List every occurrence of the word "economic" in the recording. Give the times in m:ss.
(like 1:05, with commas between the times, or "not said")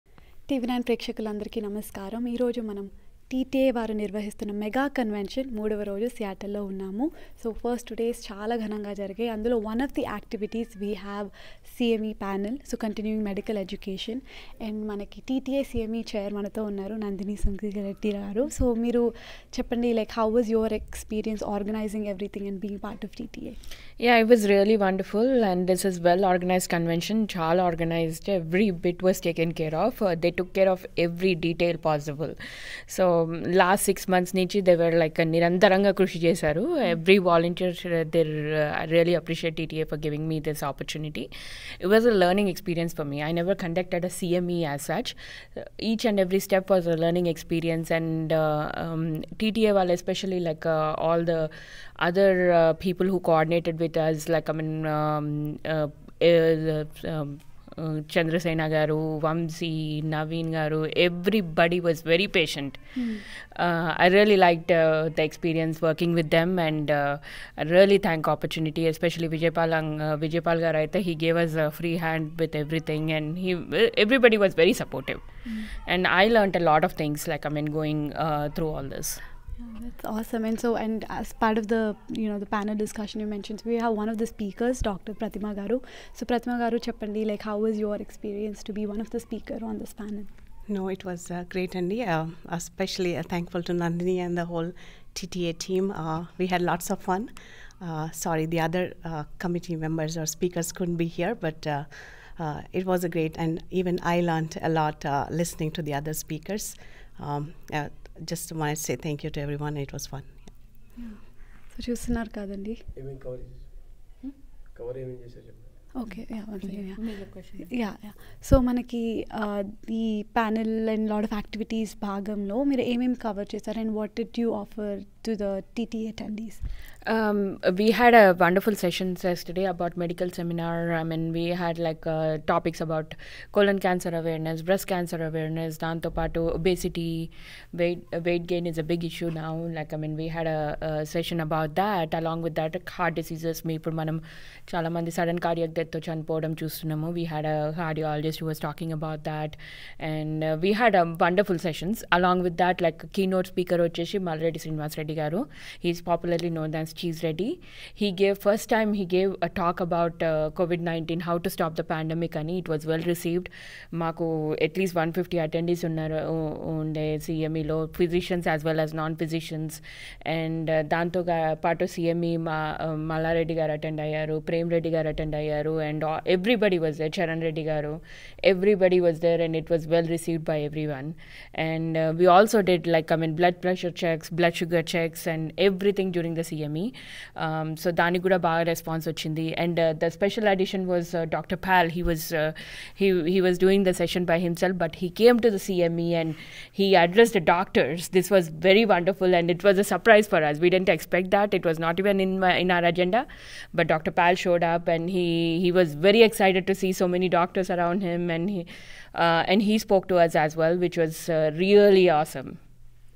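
not said.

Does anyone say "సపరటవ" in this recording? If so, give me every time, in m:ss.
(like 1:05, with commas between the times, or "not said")
1:14.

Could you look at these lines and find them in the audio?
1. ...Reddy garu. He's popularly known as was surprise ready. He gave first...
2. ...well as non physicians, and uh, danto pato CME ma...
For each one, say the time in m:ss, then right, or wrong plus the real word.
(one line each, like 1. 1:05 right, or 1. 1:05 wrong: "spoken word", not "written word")
1. 2:34 wrong: "cheese", not "surprise"
2. 2:48 right.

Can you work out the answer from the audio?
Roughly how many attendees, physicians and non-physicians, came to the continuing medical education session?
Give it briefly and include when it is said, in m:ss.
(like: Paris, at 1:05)
150, at 2:44.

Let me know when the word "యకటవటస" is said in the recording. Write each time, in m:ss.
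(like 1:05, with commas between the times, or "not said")
0:10, 2:01.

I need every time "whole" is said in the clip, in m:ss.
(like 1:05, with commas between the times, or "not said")
1:34.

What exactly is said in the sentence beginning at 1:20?
And so, and as part of the you know the panel discussion you mentioned, so we have one of the speakers, Dr.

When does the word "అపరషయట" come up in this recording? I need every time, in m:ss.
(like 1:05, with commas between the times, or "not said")
0:39.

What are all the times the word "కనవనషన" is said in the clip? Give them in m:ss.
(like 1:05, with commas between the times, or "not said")
0:04, 0:26.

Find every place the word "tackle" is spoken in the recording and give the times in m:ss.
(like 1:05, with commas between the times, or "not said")
not said.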